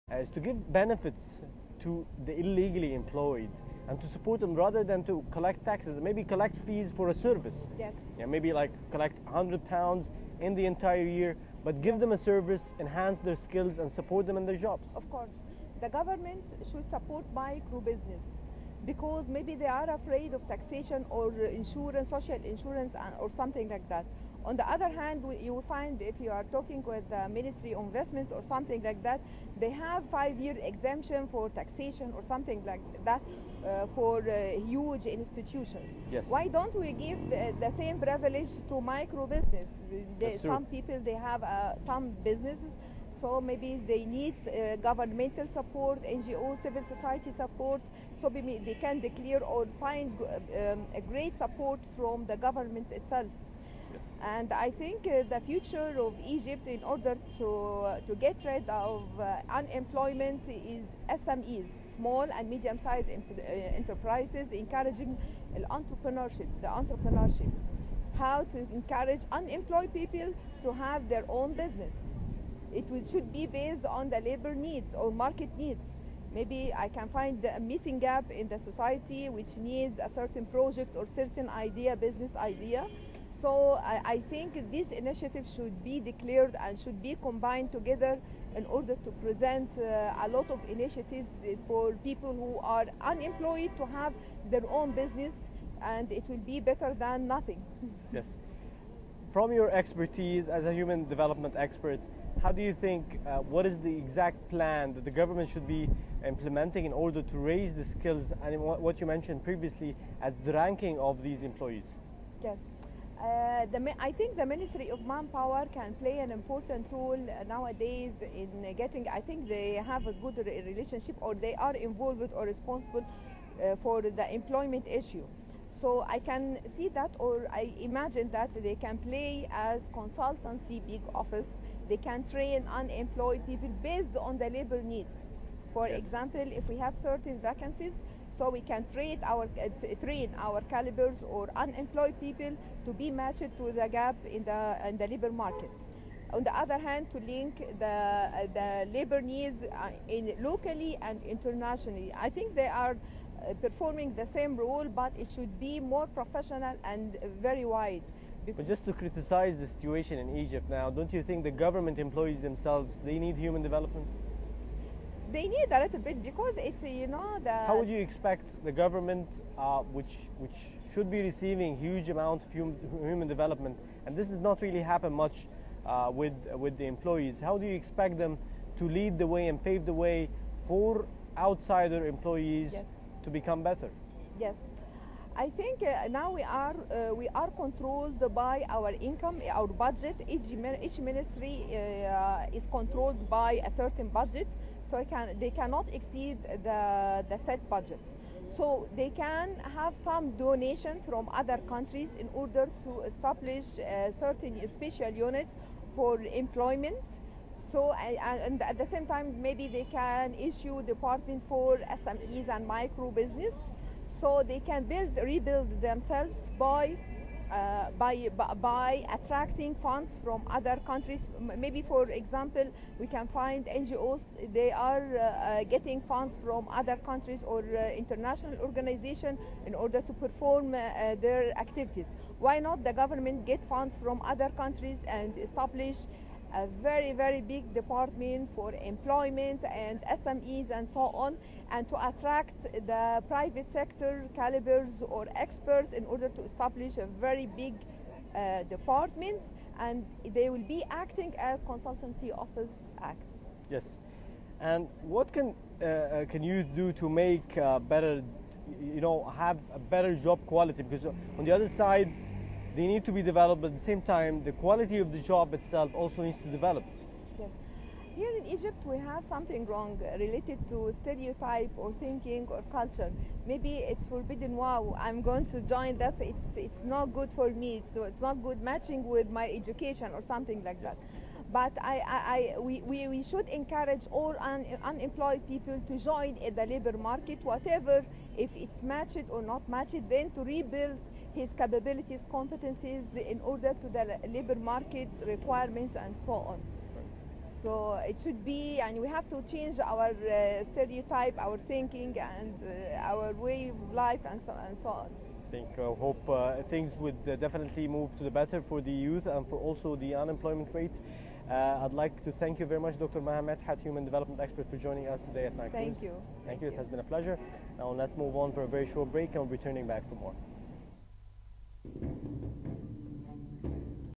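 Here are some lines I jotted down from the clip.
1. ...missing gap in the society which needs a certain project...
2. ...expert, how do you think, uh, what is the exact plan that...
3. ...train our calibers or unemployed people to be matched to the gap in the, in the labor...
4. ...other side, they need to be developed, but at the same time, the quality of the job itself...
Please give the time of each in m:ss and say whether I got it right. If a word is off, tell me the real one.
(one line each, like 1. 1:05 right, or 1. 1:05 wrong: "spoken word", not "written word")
1. 1:17 right
2. 1:41 right
3. 2:20 right
4. 4:21 right.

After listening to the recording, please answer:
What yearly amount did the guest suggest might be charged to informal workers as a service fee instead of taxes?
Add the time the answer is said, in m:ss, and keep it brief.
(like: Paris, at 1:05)
100 pounds, at 0:09.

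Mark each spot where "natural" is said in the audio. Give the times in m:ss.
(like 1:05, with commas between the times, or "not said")
not said.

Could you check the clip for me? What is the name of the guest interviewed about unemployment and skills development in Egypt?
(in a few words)
Maha Medhat.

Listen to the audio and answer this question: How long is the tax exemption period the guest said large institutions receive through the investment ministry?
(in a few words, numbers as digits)
five-year.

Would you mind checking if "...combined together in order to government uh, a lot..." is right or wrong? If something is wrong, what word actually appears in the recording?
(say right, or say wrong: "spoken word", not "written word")
wrong: "present", not "government".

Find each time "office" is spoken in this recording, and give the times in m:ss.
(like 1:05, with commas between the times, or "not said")
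2:11, 4:12.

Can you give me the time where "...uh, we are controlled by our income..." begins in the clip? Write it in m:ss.
3:06.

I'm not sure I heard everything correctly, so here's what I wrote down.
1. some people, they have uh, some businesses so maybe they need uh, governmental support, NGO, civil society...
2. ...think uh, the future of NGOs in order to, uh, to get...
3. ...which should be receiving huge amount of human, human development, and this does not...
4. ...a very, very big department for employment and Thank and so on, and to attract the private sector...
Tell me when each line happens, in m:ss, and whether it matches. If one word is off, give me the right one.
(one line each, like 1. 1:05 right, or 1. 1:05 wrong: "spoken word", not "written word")
1. 0:40 right
2. 0:54 wrong: "Egypt", not "NGOs"
3. 2:50 right
4. 3:56 wrong: "SMEs", not "Thank".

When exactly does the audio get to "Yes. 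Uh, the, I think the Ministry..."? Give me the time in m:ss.
1:52.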